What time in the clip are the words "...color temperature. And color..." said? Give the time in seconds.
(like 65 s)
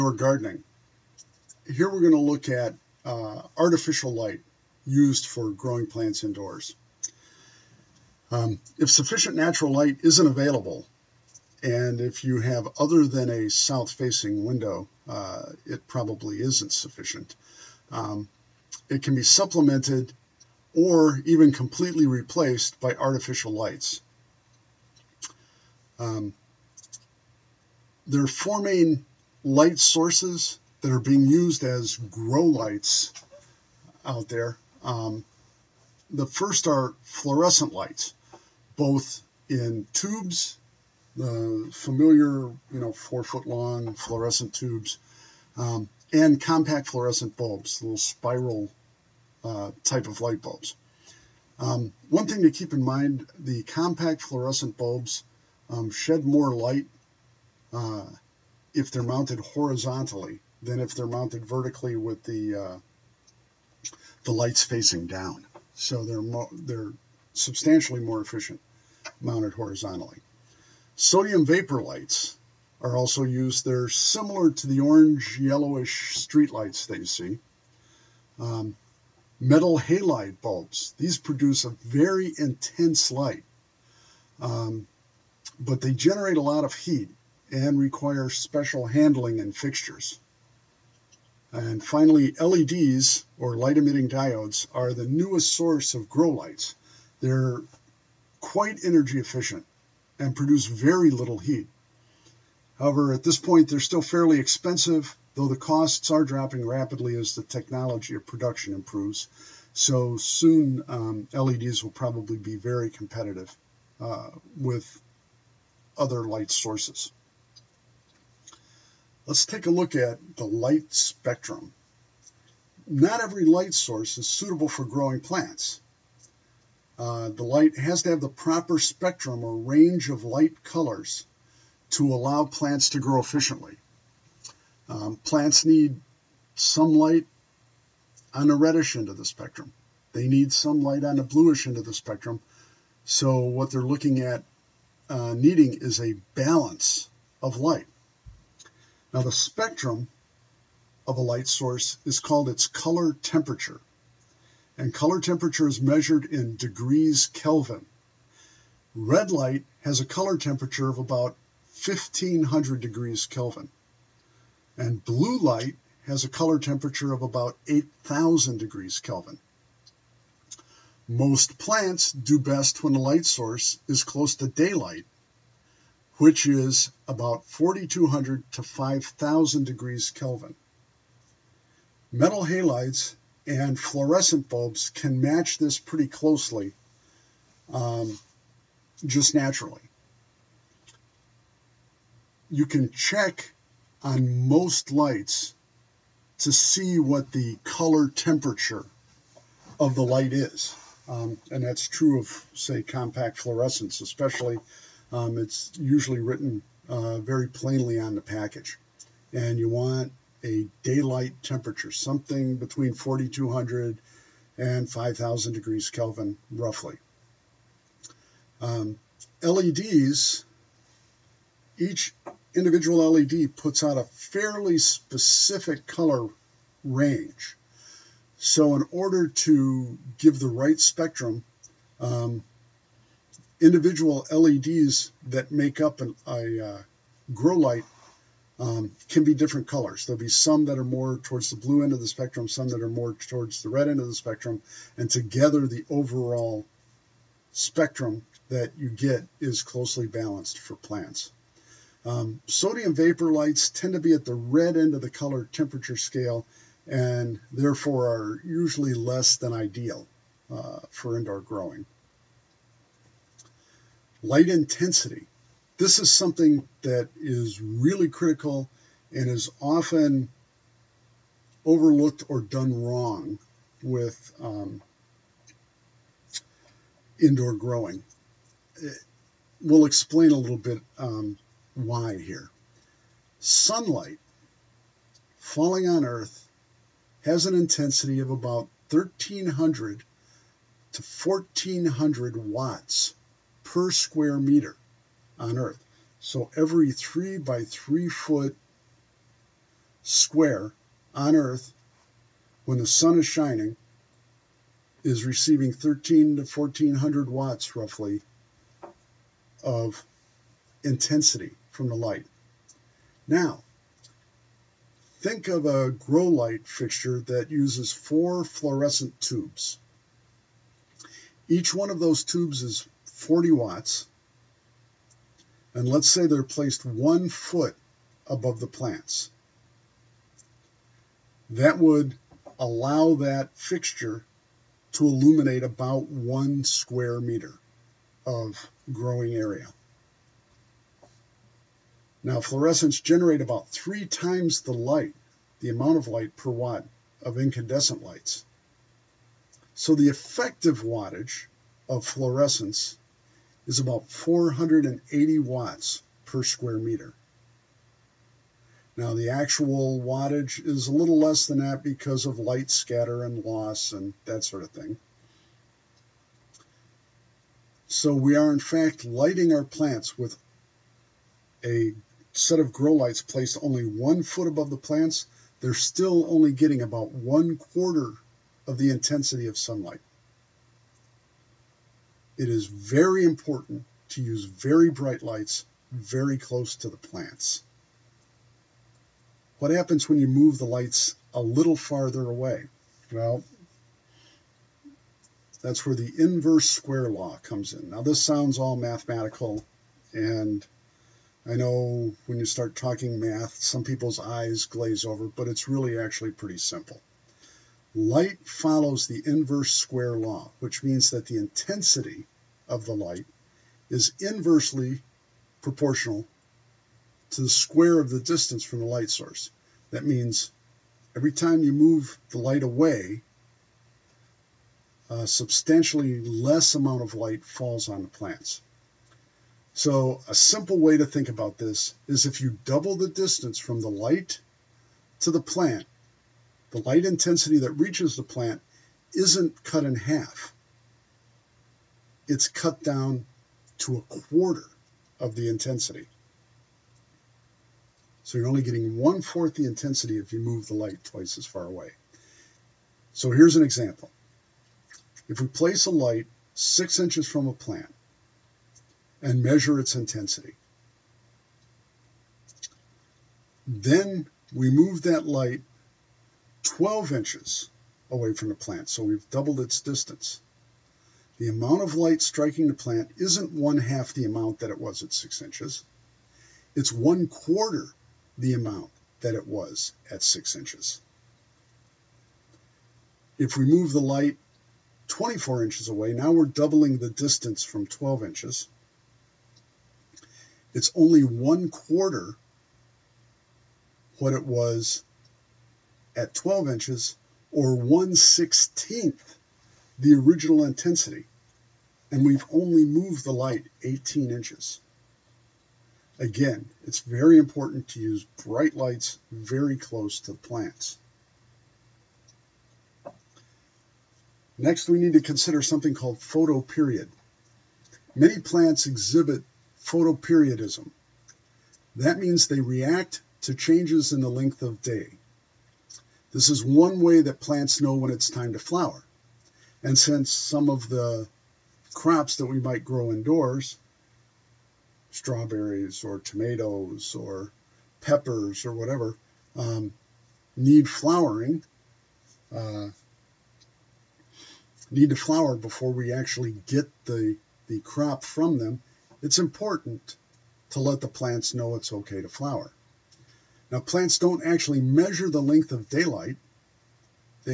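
152 s.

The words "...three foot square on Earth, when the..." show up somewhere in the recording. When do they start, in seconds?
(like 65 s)
297 s.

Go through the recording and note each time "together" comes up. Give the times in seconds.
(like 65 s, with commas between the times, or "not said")
245 s.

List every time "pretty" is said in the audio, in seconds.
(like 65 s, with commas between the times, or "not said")
185 s, 406 s.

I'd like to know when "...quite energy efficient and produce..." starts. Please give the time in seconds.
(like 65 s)
98 s.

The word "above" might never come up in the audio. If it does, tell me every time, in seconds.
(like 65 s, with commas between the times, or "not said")
328 s, 374 s.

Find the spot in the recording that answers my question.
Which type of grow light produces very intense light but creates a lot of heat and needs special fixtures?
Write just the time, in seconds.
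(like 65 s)
79 s.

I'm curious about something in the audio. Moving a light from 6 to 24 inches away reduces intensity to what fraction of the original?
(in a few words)
1/16.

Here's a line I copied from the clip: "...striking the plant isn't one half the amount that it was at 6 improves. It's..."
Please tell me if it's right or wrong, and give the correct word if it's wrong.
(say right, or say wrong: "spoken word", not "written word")
wrong: "inches", not "improves".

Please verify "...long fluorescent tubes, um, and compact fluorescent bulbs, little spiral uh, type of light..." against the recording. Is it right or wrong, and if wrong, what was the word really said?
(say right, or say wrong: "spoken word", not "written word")
right.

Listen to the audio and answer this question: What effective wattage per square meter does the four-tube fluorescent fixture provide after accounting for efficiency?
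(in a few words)
480 watts.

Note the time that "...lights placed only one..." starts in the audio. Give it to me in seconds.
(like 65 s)
372 s.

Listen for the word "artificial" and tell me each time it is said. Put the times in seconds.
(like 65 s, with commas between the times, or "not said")
3 s, 22 s.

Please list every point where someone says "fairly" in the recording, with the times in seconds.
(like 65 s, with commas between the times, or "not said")
104 s, 224 s.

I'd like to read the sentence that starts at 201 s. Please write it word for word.
Um, and that's true of, say, compact fluorescents, especially um, it's usually written uh, very plainly on the package.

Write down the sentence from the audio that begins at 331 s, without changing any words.
That would allow that fixture to illuminate about one square meter of growing area.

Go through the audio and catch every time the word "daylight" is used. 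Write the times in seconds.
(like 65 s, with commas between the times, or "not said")
174 s, 210 s, 555 s.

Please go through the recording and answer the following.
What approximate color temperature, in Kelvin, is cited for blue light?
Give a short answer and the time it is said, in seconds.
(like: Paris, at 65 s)
8000, at 167 s.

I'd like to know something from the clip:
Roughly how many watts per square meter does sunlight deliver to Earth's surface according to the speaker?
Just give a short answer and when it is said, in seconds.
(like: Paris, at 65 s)
1300 to 1400, at 288 s.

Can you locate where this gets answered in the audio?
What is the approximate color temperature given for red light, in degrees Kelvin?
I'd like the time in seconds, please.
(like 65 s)
161 s.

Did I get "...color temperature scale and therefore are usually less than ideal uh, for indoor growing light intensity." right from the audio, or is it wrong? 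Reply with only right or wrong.
right.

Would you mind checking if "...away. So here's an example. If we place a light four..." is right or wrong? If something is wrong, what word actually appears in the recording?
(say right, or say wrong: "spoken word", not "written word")
wrong: "six", not "four".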